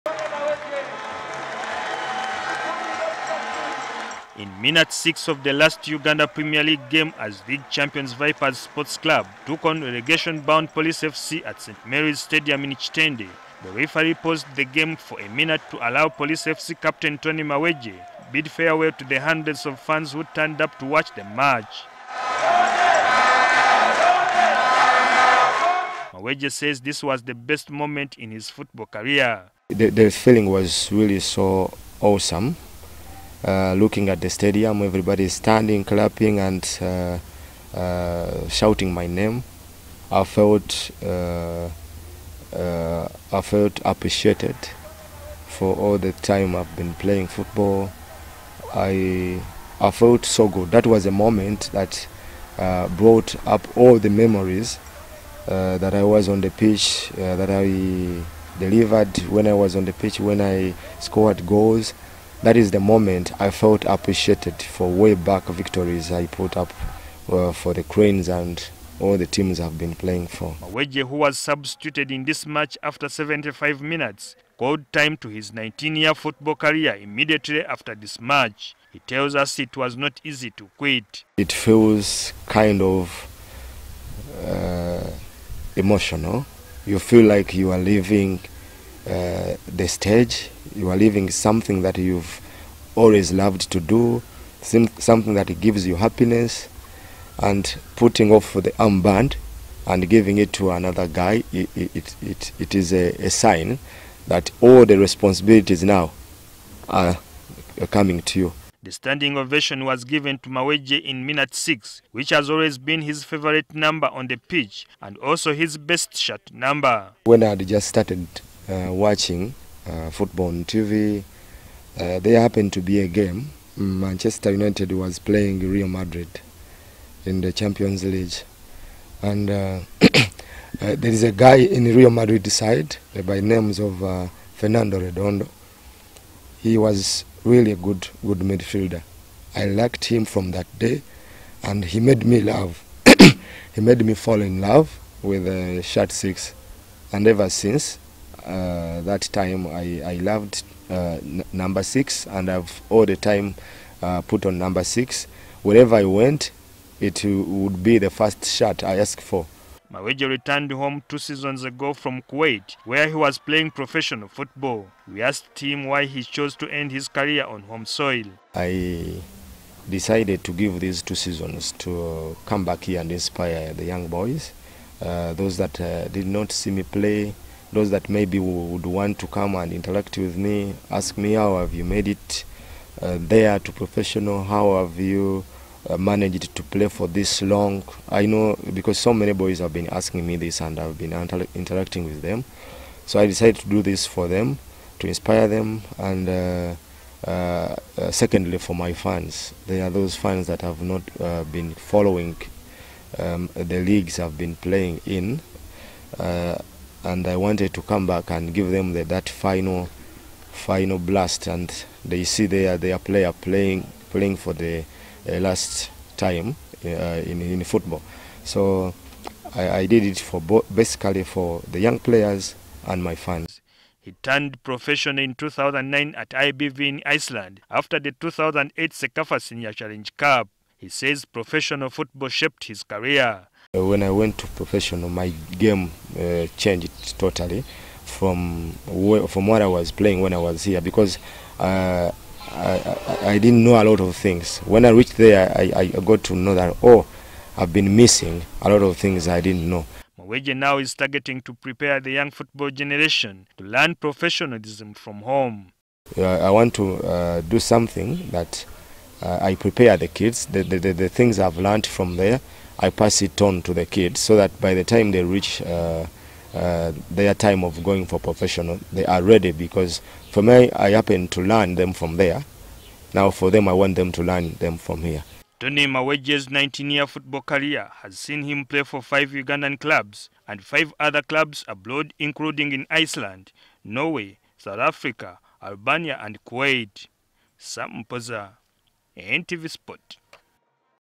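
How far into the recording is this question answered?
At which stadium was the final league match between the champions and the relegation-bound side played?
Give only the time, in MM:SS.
00:11.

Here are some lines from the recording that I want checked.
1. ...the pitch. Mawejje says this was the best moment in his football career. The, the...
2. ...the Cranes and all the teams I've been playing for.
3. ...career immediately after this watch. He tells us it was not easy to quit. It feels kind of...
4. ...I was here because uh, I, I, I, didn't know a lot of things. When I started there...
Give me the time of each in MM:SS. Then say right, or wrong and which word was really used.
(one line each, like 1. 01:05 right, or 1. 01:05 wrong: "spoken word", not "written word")
1. 00:21 wrong: "match", not "pitch"
2. 01:07 right
3. 01:16 wrong: "match", not "watch"
4. 04:00 wrong: "reached", not "started".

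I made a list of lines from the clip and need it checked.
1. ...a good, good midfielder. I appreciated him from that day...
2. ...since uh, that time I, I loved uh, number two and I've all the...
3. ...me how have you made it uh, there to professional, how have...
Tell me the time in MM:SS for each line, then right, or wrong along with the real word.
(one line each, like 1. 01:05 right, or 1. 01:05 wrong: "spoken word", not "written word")
1. 02:17 wrong: "liked", not "appreciated"
2. 02:27 wrong: "six", not "two"
3. 03:01 right.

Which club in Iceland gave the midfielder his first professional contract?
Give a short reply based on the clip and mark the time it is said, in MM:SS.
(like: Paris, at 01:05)
IBV, at 03:46.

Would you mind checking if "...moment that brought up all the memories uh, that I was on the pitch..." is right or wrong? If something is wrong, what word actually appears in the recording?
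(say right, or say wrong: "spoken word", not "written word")
right.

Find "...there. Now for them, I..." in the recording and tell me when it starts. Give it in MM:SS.
04:32.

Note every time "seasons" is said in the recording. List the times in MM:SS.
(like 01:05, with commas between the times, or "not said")
02:41, 02:51.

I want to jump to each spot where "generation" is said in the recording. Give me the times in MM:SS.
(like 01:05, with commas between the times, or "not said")
04:12.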